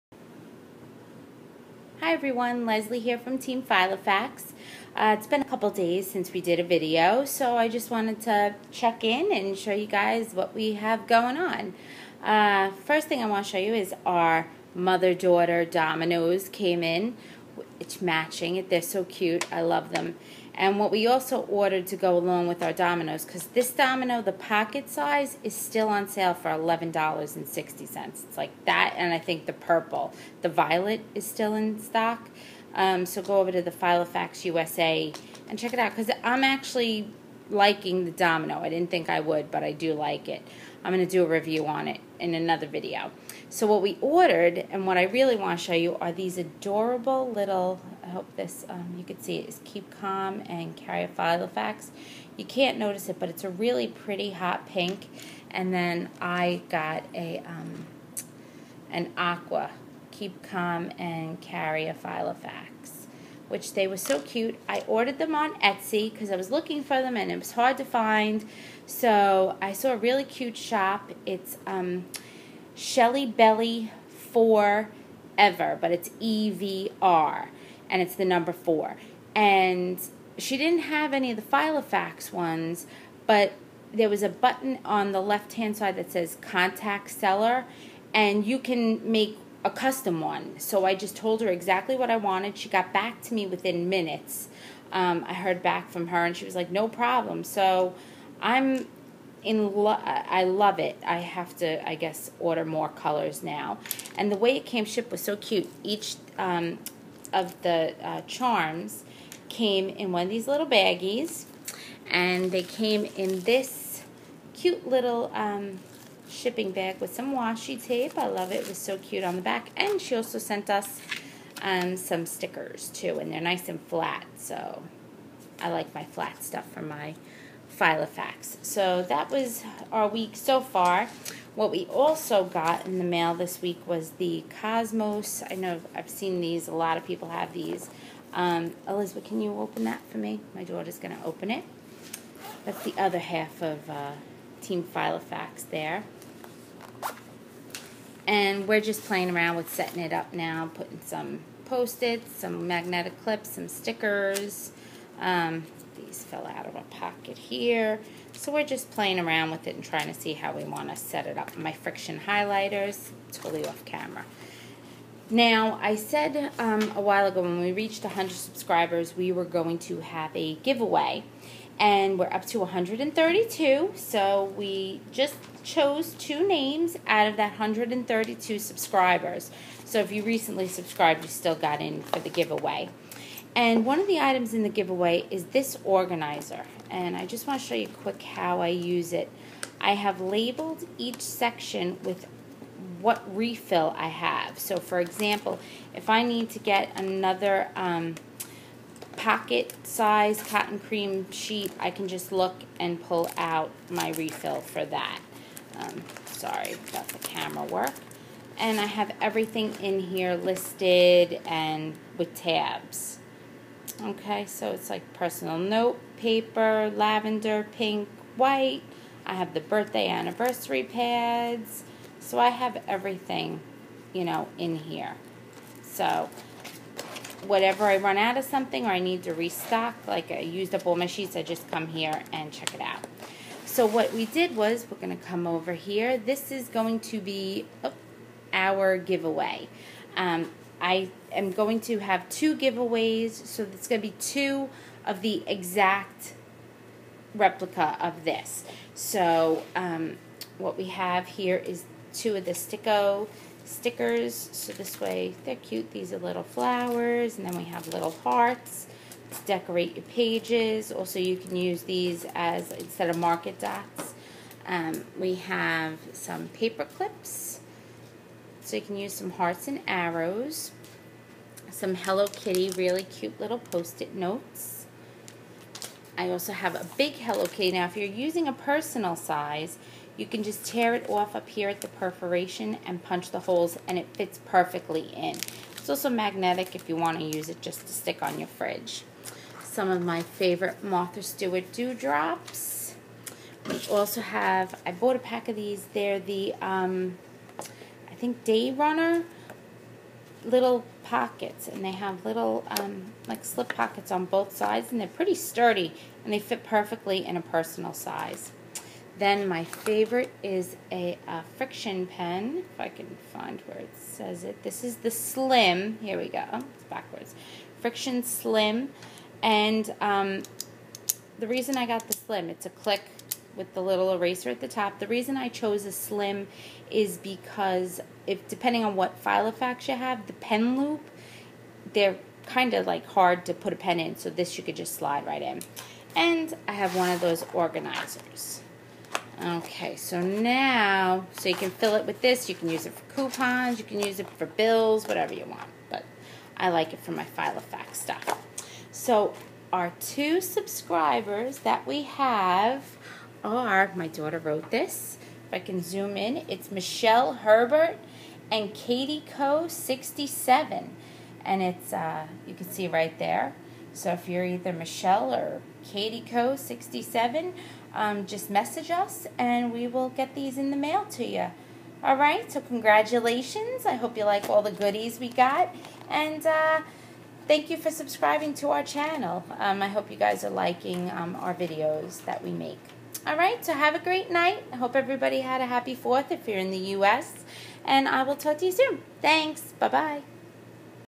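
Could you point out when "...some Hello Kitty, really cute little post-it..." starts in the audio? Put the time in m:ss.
4:31.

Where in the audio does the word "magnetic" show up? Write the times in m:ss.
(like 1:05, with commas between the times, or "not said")
2:32, 4:46.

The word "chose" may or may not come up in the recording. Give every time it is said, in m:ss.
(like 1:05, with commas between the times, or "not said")
2:55, 5:25.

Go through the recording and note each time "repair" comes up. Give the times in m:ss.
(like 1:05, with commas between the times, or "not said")
not said.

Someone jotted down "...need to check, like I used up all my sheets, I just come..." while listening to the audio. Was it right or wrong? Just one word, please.
wrong.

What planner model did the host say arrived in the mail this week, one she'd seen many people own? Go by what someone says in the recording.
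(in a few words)
Cosmos.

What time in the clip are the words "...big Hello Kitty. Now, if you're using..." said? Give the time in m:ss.
4:36.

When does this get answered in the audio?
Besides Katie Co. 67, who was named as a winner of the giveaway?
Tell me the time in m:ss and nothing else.
5:56.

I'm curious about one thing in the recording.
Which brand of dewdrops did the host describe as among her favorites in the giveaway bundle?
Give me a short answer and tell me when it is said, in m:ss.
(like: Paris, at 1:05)
Martha Stewart, at 4:50.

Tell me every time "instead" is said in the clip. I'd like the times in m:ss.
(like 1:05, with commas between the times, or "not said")
4:22.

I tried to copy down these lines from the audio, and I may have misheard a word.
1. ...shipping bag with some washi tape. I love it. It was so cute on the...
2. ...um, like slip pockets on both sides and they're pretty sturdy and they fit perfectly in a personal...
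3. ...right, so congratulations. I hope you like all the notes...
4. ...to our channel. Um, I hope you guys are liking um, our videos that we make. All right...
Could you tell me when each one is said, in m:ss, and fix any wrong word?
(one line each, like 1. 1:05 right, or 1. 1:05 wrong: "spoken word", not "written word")
1. 1:56 right
2. 5:02 right
3. 6:12 wrong: "goodies", not "notes"
4. 6:18 right.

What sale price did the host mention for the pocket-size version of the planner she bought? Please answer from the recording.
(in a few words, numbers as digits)
$11.60.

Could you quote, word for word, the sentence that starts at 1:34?
Um, I heard back from her, and she was like, "No problem." So I'm in lo- I love it.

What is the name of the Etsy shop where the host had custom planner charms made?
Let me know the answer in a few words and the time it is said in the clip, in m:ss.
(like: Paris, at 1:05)
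Shelly Belly Forever, at 1:12.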